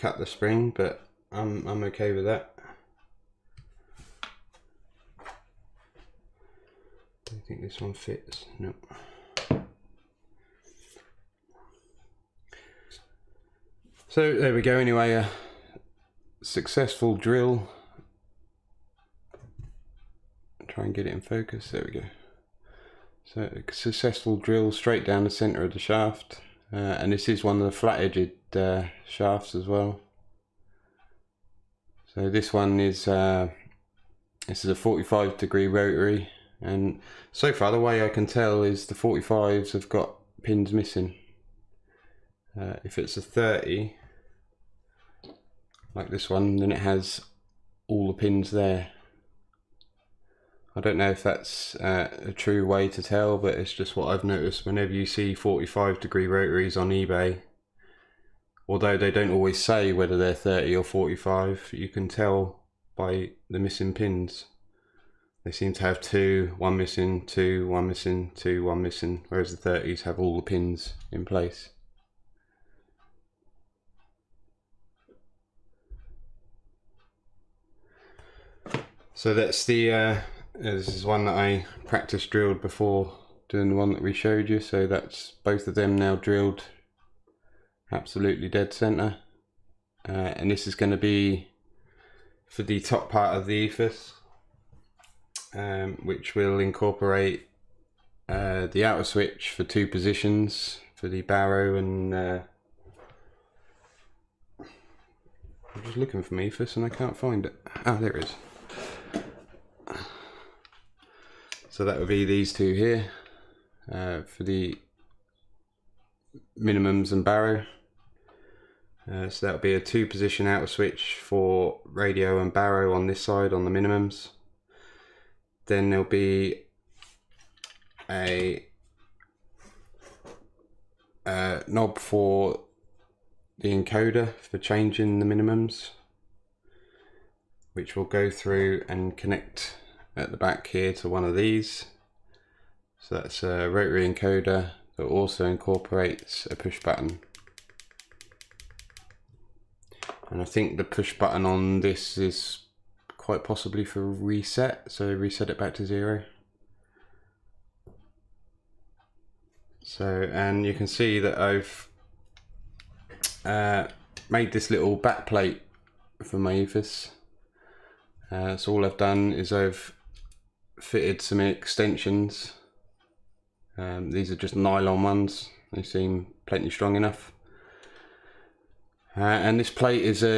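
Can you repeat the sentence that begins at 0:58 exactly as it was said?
Although they don't always say whether they're 30 or 45, you can tell by the missing pins.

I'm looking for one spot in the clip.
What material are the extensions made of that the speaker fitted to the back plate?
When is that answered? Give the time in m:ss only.
2:54.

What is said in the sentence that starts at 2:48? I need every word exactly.
Uh, so all I've done is I've fitted some extensions.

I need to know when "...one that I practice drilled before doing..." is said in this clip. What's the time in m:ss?
1:21.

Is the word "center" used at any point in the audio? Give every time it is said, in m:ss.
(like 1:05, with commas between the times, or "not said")
0:25, 1:28.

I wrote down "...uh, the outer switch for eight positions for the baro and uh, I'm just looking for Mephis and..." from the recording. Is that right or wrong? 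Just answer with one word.
wrong.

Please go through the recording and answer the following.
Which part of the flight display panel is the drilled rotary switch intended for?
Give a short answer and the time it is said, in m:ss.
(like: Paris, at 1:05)
top part of the EFIS, at 1:32.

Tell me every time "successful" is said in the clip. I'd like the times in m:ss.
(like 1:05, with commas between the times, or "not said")
0:16, 0:23.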